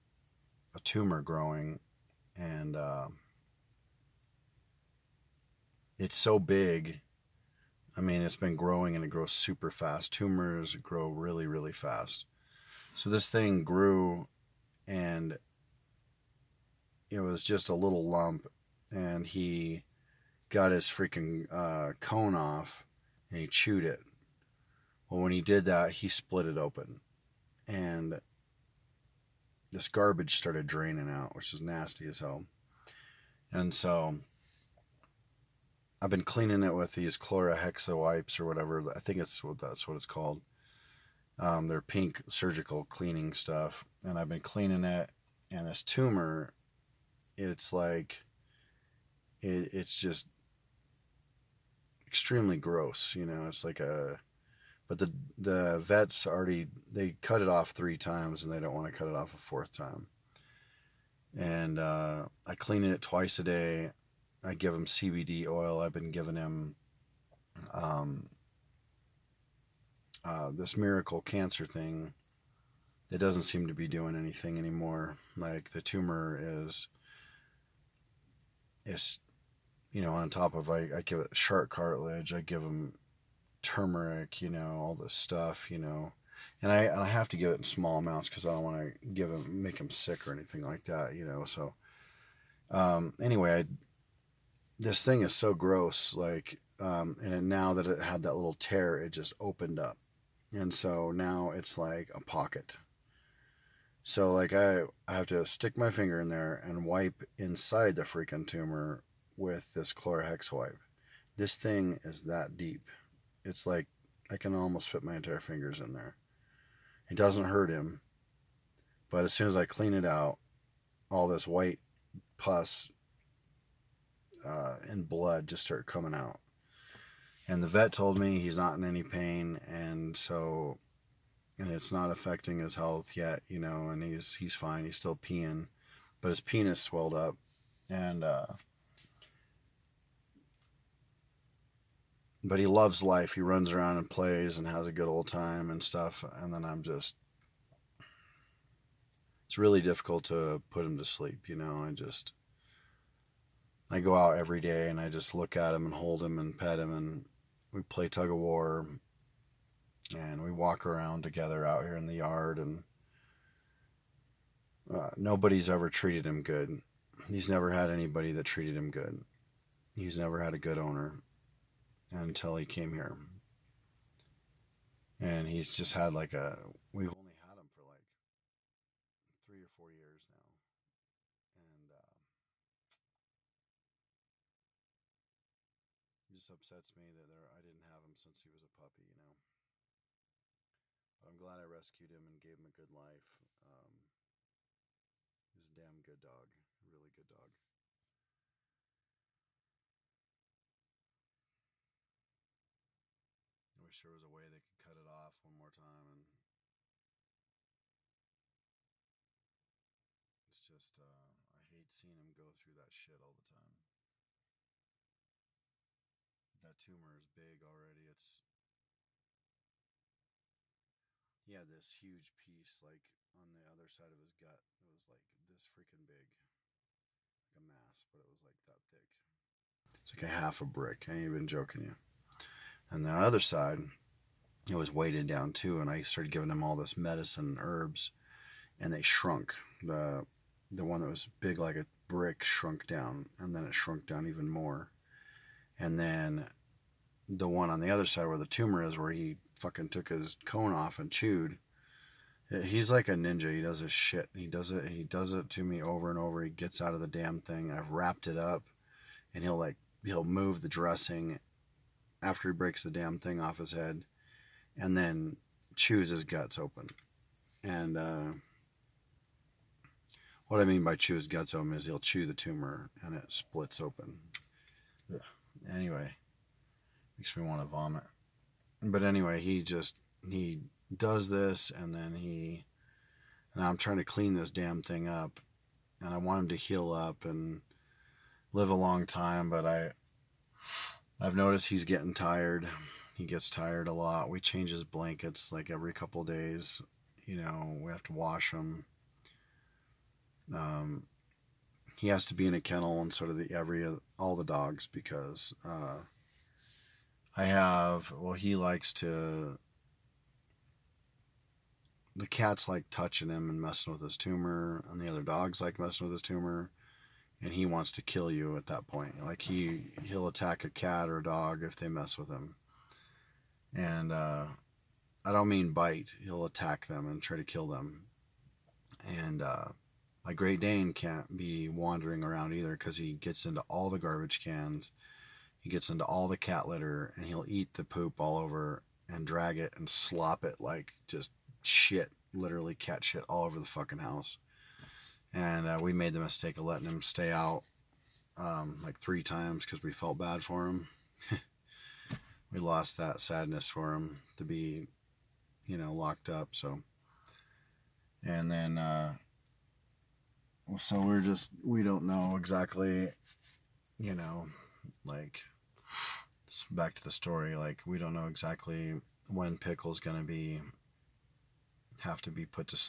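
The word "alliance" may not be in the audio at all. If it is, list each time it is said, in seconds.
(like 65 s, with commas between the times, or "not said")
not said.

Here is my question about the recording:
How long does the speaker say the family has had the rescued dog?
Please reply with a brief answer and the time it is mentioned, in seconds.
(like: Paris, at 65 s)
3 or 4 years, at 179 s.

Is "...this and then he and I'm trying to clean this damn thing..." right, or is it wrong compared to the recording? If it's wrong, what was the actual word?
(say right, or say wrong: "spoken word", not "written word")
right.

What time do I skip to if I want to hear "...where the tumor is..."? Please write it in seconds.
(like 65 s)
248 s.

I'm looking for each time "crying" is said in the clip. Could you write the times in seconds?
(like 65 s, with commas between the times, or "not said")
not said.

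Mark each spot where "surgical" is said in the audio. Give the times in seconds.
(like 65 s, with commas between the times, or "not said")
42 s.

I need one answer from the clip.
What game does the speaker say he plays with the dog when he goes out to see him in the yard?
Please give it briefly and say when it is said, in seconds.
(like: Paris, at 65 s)
tug of war, at 158 s.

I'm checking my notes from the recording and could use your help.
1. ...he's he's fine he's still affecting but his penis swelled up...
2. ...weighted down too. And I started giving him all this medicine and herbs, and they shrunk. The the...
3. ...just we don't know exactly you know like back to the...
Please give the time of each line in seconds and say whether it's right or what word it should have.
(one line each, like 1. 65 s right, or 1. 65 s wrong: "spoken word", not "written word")
1. 134 s wrong: "peeing", not "affecting"
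2. 234 s right
3. 361 s right.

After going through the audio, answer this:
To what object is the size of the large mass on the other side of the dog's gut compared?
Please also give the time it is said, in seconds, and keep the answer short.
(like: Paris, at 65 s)
half a brick, at 230 s.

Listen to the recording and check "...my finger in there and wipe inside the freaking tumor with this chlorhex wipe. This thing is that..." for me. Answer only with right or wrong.
right.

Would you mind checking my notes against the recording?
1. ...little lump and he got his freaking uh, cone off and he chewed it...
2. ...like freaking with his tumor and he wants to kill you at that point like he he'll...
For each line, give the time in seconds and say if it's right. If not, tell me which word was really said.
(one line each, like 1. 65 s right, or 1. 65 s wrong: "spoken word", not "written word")
1. 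17 s right
2. 315 s wrong: "messing", not "freaking".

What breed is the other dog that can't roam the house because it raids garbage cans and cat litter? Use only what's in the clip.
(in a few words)
Great Dane.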